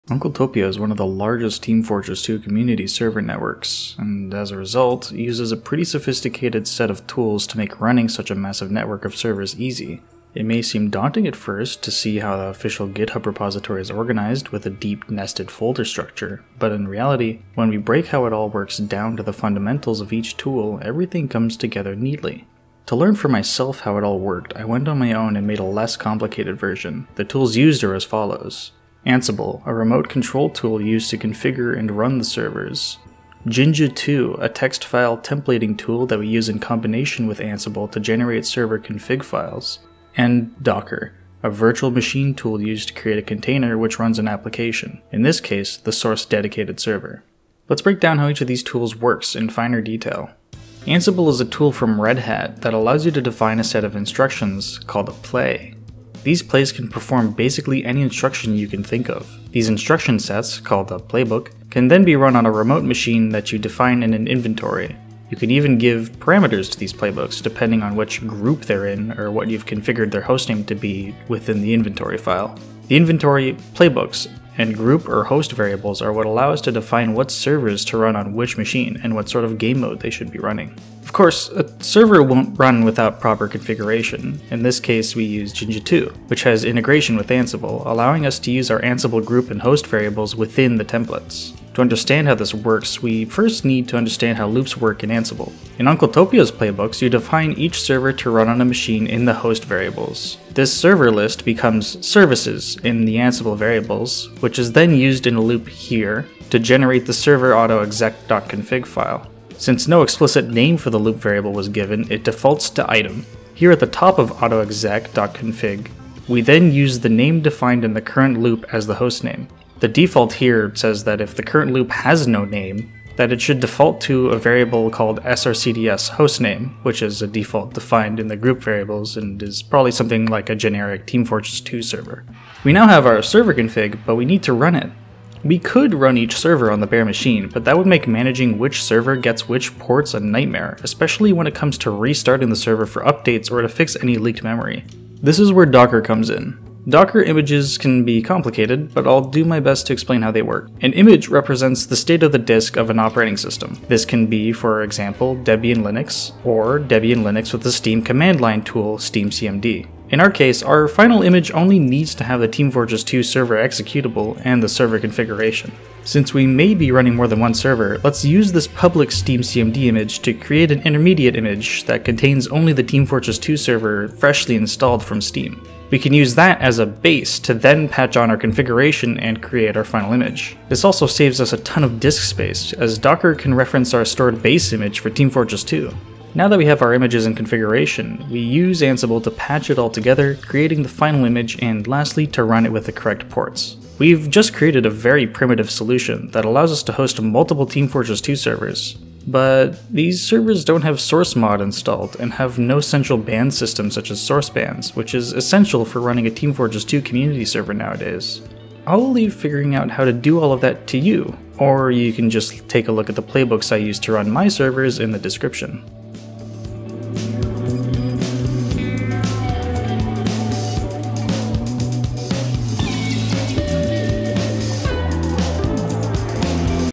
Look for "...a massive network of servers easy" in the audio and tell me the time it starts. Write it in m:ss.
0:08.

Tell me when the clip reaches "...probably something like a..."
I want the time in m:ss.
2:09.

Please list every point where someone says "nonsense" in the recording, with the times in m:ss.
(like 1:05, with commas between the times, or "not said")
not said.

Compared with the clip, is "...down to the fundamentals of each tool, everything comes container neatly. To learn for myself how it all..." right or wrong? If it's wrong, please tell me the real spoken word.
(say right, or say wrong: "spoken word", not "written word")
wrong: "together", not "container".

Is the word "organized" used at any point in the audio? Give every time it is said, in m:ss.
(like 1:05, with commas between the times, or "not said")
0:13.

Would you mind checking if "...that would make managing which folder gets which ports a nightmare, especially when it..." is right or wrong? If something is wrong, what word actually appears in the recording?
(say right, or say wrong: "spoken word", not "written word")
wrong: "server", not "folder".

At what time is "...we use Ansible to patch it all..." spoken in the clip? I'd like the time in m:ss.
3:08.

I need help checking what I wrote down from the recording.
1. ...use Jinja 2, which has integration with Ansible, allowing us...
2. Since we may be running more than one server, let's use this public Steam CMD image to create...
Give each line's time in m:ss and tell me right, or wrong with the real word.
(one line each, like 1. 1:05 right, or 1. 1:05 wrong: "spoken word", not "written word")
1. 1:25 right
2. 2:46 right.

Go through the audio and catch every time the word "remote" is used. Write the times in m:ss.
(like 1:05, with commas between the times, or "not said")
0:29, 1:02.